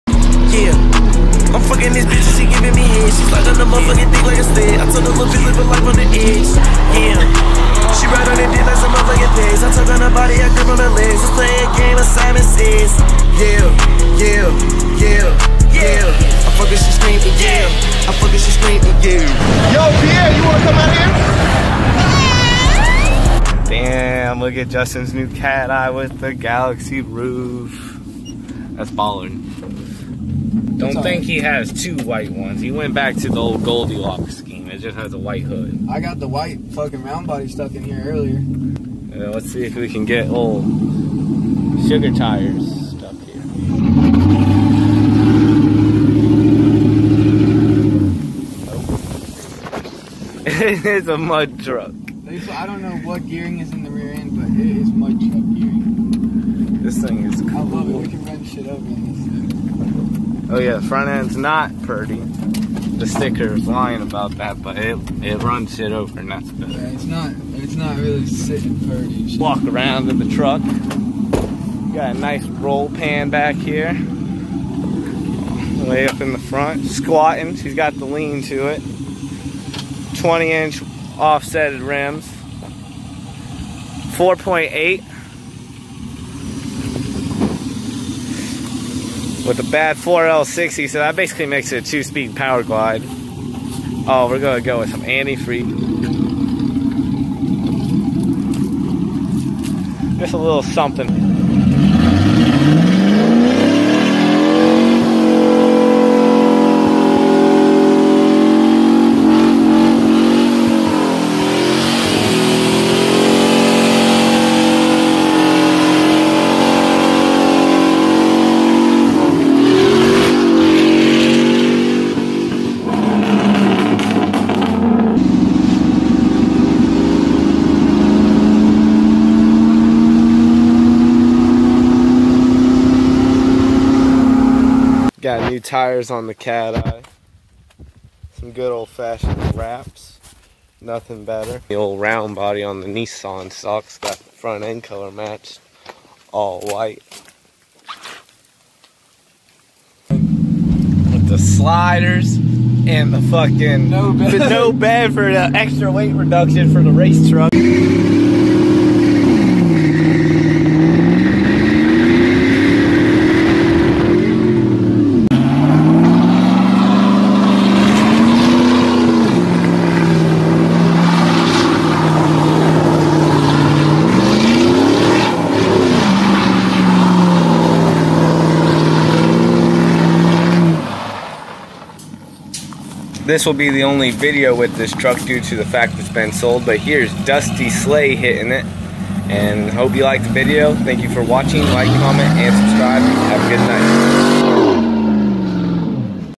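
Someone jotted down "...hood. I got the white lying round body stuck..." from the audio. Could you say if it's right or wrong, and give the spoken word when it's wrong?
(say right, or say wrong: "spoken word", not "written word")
wrong: "fucking", not "lying".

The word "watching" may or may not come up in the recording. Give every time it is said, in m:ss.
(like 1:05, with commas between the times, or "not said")
3:11.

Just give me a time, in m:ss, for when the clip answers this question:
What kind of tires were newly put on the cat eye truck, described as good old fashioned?
2:19.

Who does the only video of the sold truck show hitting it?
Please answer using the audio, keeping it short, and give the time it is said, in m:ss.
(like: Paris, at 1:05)
Dusty Slay, at 3:07.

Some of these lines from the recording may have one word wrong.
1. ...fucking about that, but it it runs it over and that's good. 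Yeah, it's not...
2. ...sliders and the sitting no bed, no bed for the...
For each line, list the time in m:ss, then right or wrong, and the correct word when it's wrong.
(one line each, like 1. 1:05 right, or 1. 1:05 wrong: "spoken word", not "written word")
1. 1:03 wrong: "lying", not "fucking"
2. 2:31 wrong: "fucking", not "sitting".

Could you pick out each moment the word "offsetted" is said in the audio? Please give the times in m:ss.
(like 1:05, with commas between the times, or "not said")
1:21.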